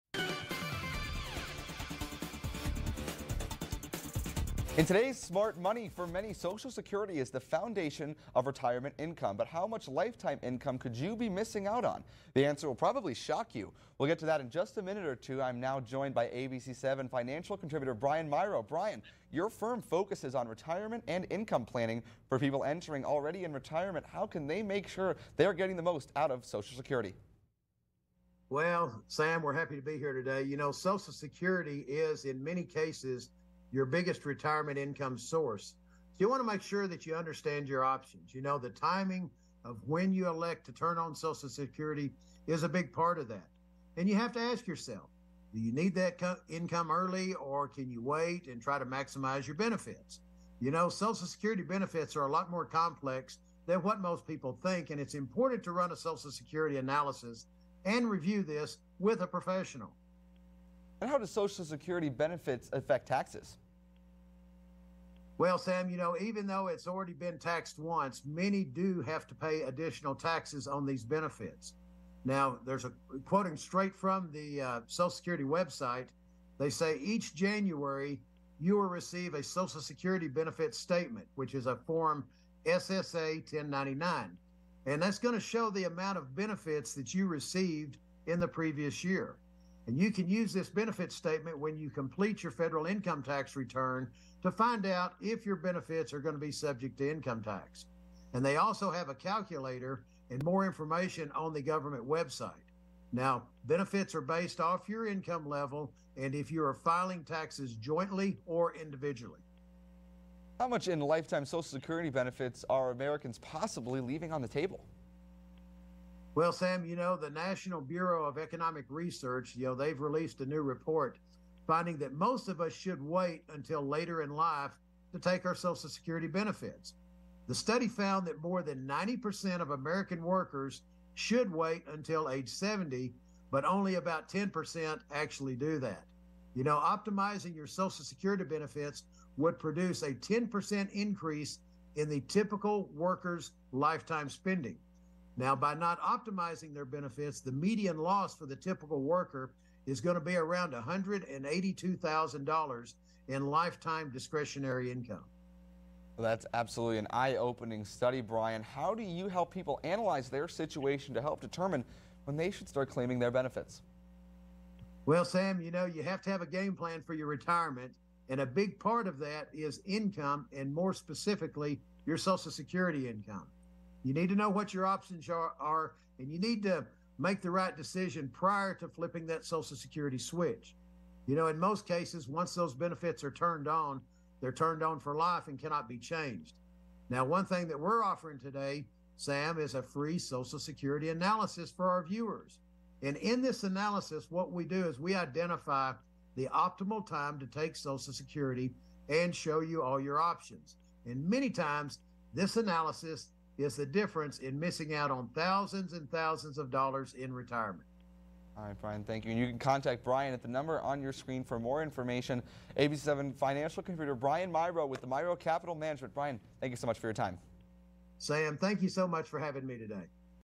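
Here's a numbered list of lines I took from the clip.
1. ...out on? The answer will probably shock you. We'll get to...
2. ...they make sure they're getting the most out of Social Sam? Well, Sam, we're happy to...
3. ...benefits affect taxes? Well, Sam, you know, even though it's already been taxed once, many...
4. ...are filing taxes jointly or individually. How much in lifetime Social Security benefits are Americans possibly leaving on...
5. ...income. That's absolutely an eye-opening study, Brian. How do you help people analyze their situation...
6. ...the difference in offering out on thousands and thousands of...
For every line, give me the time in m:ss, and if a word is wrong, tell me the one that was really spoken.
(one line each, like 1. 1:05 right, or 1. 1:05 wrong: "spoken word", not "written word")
1. 0:11 right
2. 0:24 wrong: "Security", not "Sam"
3. 1:02 right
4. 1:46 right
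5. 2:34 right
6. 3:23 wrong: "missing", not "offering".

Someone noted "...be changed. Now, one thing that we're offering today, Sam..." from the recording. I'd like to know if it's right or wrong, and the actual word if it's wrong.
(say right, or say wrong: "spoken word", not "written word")
right.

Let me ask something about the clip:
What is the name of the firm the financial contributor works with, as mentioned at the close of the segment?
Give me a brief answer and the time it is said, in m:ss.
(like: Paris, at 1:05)
Mirau Capital Management, at 3:35.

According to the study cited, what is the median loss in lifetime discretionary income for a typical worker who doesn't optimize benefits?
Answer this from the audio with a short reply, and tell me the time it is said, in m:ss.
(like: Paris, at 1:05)
$182,000, at 2:30.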